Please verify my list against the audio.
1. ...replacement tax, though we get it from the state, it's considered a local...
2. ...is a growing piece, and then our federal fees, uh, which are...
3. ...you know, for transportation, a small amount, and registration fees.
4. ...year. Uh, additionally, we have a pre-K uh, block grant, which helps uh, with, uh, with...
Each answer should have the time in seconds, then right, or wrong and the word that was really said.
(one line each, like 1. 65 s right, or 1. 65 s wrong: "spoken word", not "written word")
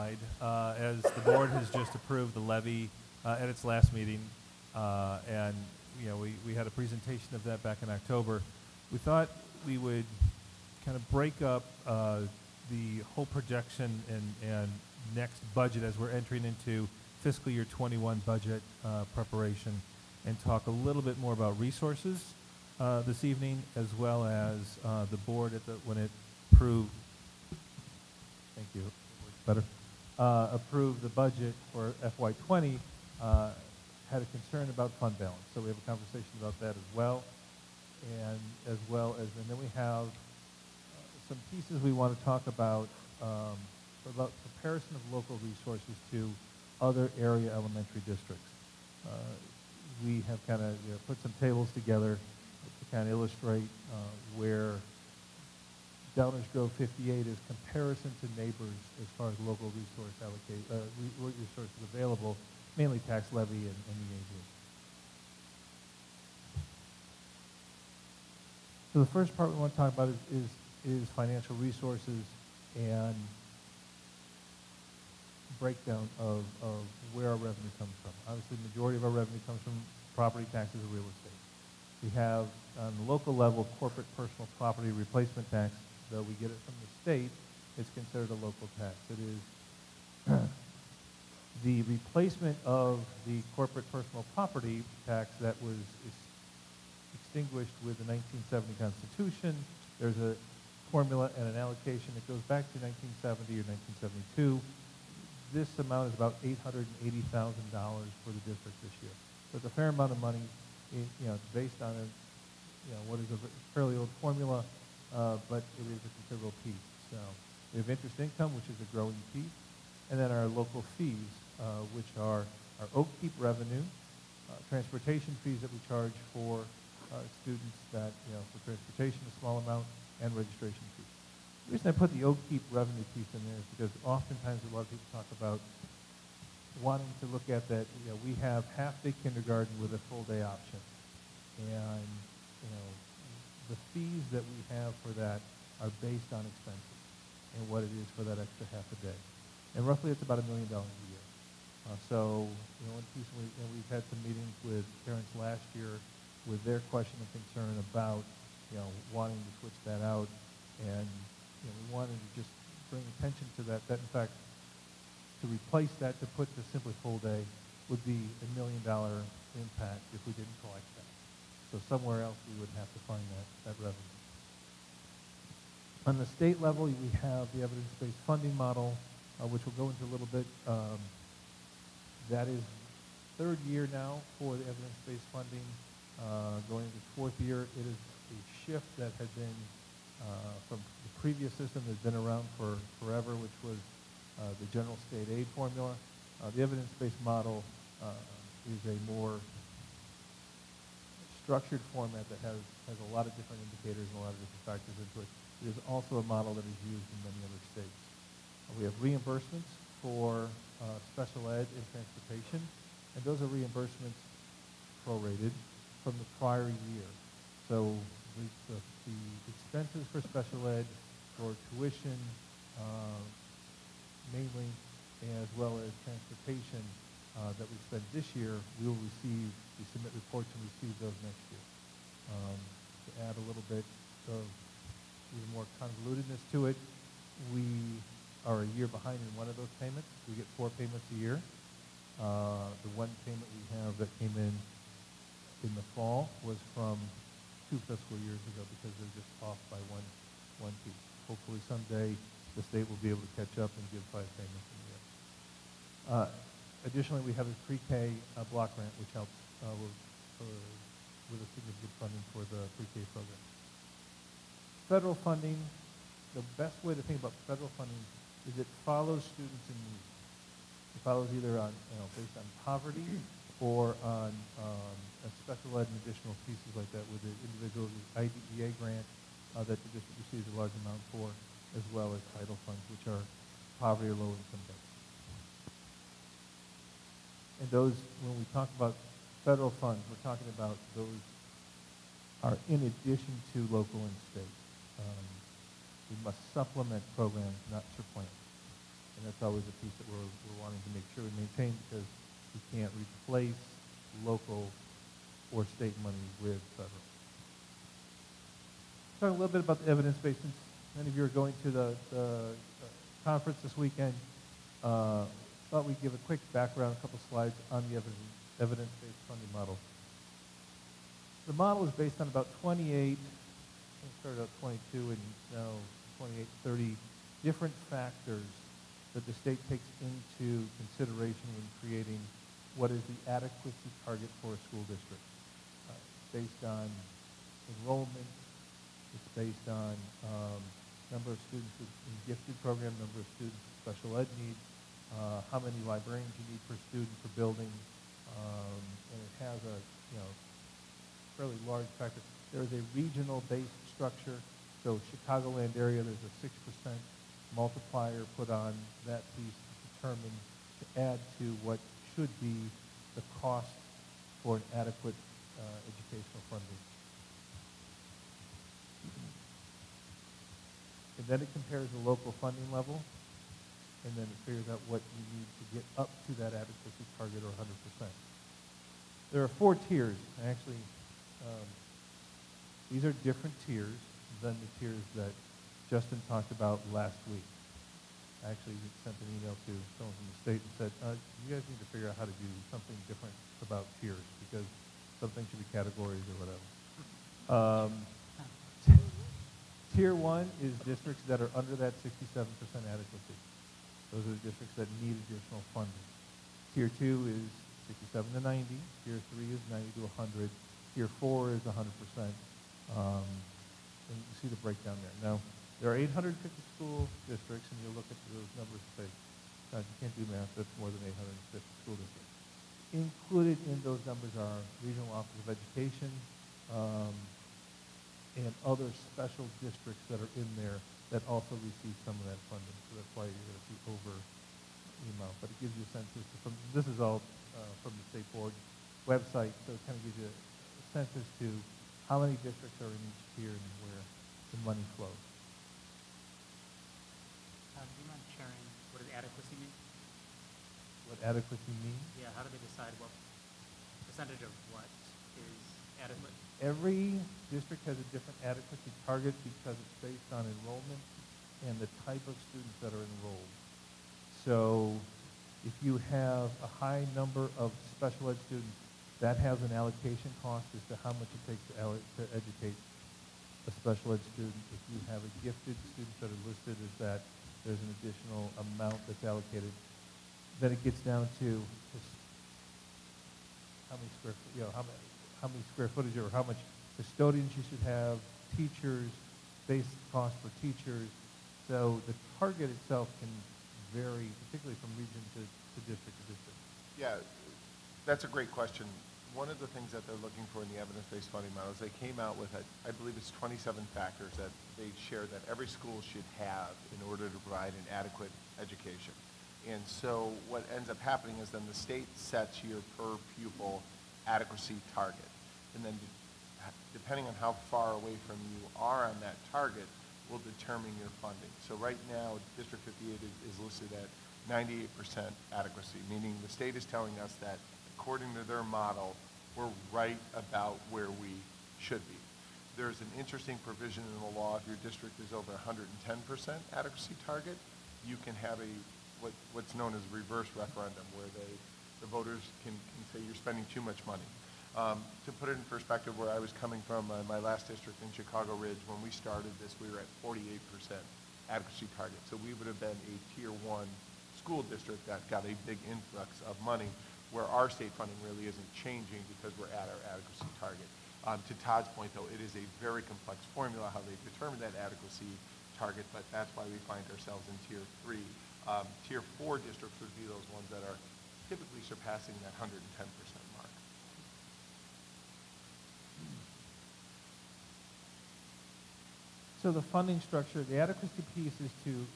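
1. 84 s right
2. 118 s wrong: "local", not "federal"
3. 128 s right
4. 254 s right.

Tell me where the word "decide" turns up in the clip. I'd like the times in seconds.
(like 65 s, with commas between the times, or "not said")
452 s.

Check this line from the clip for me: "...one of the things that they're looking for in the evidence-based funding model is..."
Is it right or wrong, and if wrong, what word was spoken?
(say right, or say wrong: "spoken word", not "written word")
right.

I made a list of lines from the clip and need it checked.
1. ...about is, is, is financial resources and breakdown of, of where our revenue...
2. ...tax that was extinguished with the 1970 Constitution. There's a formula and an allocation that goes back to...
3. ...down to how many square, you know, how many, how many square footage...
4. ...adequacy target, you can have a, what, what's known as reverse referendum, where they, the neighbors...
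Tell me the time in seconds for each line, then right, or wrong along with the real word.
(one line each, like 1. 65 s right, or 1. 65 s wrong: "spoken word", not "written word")
1. 69 s right
2. 95 s right
3. 480 s right
4. 536 s wrong: "voters", not "neighbors".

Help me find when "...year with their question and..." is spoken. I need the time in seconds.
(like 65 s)
155 s.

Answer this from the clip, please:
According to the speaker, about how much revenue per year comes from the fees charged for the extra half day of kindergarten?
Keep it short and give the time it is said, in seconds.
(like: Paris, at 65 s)
About $1 million, at 150 s.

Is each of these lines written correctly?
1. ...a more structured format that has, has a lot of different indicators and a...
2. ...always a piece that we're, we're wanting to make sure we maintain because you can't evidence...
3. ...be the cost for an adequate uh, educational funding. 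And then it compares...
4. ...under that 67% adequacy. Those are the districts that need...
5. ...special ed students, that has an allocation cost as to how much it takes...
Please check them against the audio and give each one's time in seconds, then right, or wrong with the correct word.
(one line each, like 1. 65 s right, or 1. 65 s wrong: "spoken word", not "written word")
1. 198 s right
2. 299 s wrong: "replace", not "evidence"
3. 362 s right
4. 401 s right
5. 467 s right.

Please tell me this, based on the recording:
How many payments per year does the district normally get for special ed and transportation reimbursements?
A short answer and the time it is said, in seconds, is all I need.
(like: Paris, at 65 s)
4, at 240 s.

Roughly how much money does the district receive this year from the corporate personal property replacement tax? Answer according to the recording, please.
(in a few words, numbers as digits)
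$880,000.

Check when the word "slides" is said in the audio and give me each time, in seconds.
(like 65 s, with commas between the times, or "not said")
317 s.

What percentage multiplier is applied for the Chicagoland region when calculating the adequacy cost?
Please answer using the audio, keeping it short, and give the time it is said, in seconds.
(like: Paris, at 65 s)
6%, at 356 s.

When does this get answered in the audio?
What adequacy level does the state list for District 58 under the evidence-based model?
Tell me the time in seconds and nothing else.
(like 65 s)
524 s.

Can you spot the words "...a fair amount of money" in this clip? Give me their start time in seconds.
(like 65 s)
109 s.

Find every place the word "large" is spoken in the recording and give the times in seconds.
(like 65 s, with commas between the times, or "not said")
280 s, 351 s.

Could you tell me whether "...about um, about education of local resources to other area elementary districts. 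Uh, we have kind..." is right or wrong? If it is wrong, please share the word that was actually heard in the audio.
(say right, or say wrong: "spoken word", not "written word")
wrong: "comparison", not "education".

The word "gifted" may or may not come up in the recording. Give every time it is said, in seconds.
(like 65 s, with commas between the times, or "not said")
342 s, 475 s.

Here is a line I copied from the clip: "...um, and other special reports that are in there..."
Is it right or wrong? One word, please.
wrong.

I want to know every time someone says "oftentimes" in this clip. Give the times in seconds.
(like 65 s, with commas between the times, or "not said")
134 s.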